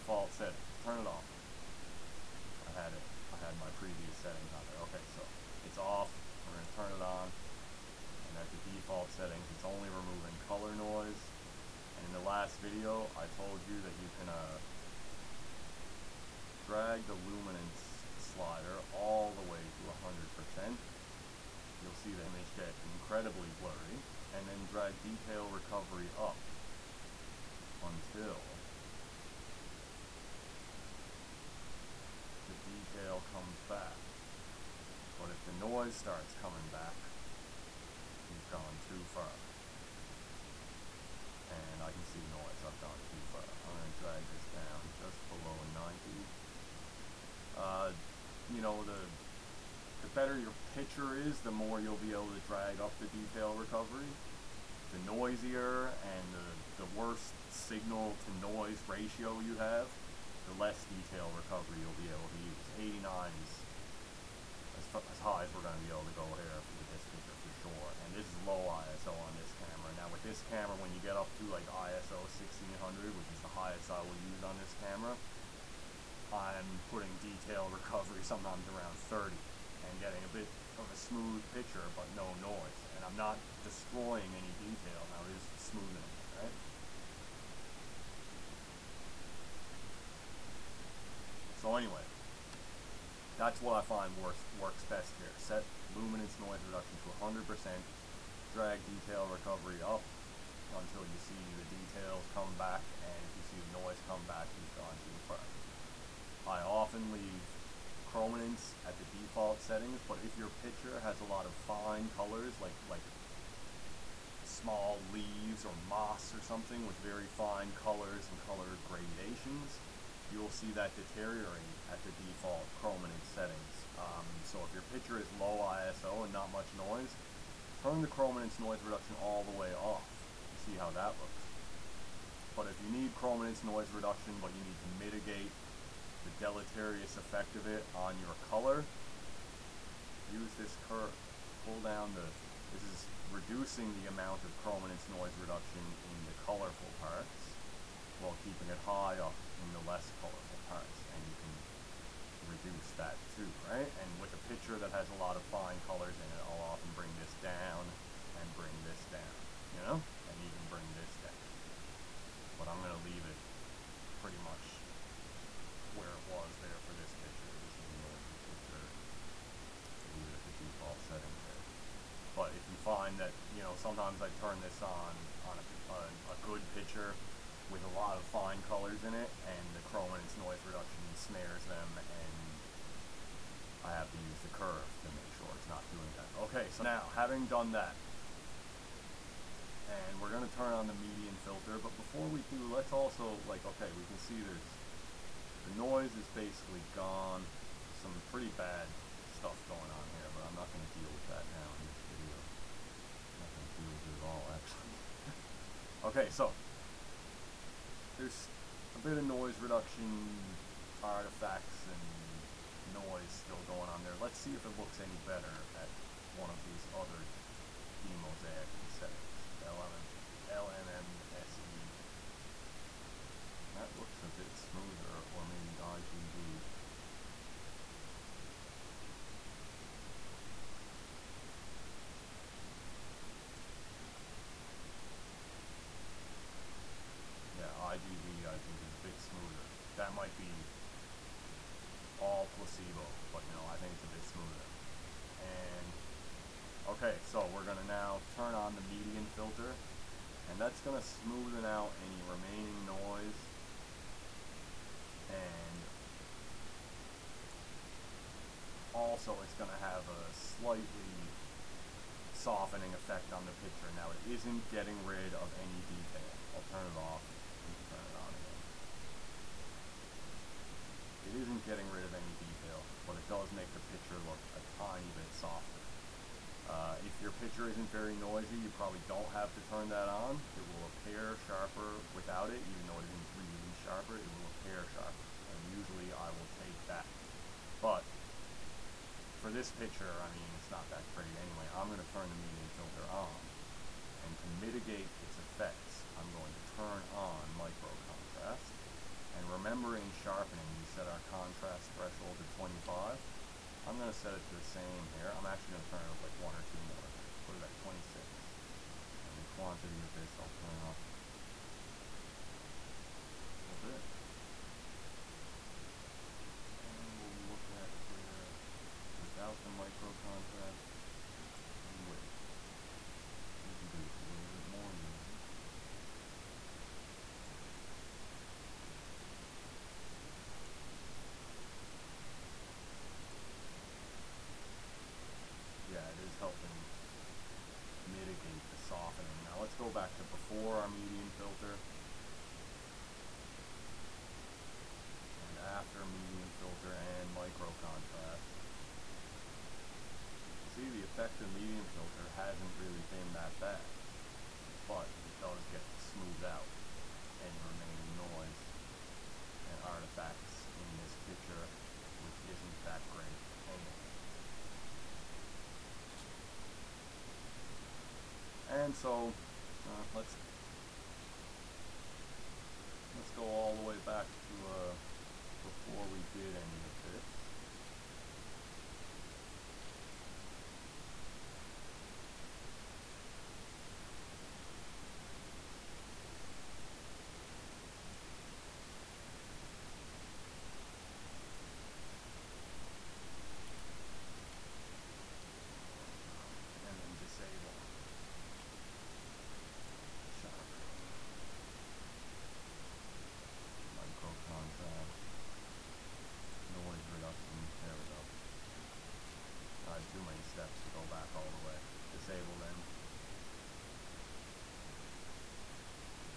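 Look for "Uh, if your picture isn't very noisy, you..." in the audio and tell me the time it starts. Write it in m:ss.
4:36.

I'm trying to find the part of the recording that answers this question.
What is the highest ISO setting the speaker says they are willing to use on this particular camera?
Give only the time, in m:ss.
1:11.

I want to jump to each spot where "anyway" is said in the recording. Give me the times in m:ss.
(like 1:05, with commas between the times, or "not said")
1:31, 4:51, 6:03.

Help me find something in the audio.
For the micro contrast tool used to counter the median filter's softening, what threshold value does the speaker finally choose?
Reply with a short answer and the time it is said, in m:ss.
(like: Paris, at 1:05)
26, at 5:07.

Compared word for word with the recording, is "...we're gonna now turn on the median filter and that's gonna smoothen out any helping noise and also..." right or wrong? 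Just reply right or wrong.
wrong.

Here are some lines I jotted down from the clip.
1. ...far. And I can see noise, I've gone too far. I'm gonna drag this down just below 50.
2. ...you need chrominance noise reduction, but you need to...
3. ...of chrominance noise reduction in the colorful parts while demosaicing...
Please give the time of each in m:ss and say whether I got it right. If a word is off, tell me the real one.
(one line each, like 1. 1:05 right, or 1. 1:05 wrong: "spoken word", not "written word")
1. 0:39 wrong: "90", not "50"
2. 2:12 right
3. 2:24 wrong: "keeping", not "demosaicing".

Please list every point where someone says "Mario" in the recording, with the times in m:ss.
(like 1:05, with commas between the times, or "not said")
not said.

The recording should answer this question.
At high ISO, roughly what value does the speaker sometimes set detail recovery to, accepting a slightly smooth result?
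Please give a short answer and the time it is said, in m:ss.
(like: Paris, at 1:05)
30, at 1:18.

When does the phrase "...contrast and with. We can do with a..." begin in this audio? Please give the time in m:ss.
5:20.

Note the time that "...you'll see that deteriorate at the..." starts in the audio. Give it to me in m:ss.
2:00.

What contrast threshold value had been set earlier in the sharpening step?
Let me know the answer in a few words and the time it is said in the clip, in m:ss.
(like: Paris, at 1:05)
25, at 5:02.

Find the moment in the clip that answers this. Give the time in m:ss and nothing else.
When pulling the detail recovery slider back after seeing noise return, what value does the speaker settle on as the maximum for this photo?
1:02.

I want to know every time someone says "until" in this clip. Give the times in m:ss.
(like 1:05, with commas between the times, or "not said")
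0:27, 1:40.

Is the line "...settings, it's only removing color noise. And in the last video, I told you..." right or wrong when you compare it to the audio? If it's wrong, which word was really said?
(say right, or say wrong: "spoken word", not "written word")
right.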